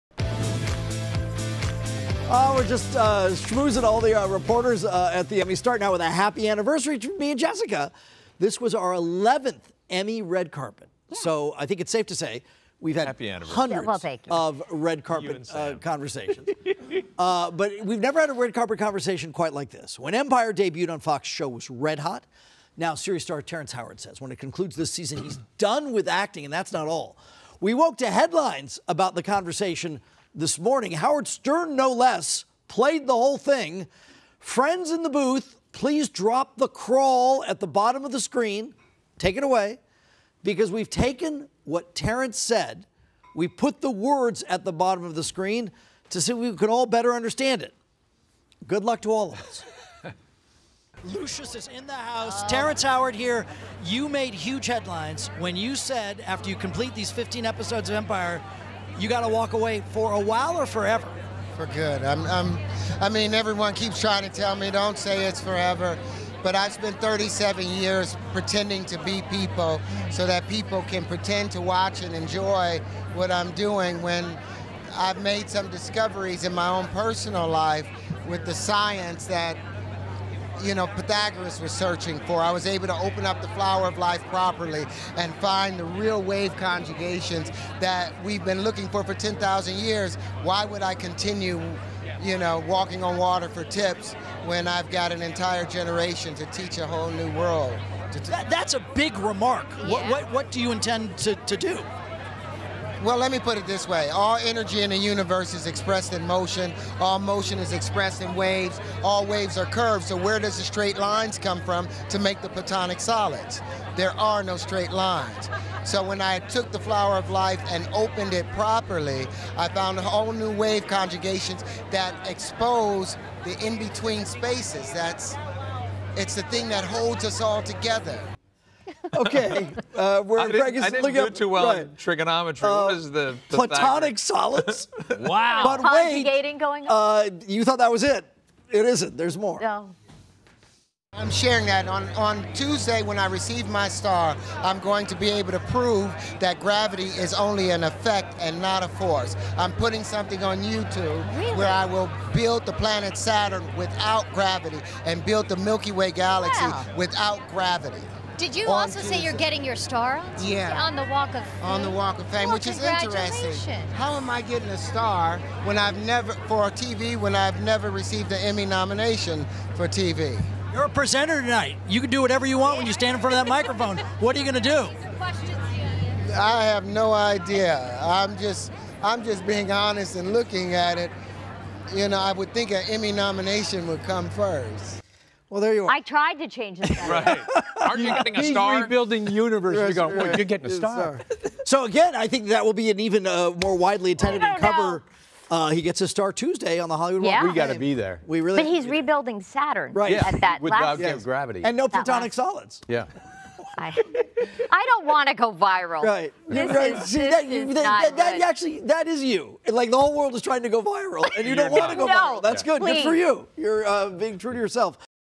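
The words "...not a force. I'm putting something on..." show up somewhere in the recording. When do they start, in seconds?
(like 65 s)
148 s.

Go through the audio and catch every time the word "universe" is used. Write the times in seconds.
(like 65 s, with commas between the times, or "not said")
104 s, 189 s.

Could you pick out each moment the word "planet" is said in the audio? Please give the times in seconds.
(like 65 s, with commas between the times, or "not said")
152 s.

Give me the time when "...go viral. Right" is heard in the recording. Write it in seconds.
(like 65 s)
205 s.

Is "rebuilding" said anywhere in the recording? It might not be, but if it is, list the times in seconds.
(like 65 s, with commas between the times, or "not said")
188 s, 198 s.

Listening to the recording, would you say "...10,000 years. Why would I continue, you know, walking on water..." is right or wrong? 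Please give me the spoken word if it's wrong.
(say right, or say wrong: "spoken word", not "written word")
right.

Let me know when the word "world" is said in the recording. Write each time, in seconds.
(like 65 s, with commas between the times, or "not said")
97 s, 210 s.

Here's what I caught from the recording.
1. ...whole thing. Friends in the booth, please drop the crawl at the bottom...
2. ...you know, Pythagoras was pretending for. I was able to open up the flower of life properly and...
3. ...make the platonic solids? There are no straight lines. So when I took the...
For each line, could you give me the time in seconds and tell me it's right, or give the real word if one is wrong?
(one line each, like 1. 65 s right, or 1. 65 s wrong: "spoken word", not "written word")
1. 33 s right
2. 80 s wrong: "searching", not "pretending"
3. 112 s right.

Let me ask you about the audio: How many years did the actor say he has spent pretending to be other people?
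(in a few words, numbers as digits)
37.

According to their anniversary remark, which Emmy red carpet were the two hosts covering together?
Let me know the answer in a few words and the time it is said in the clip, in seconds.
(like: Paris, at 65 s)
11th, at 8 s.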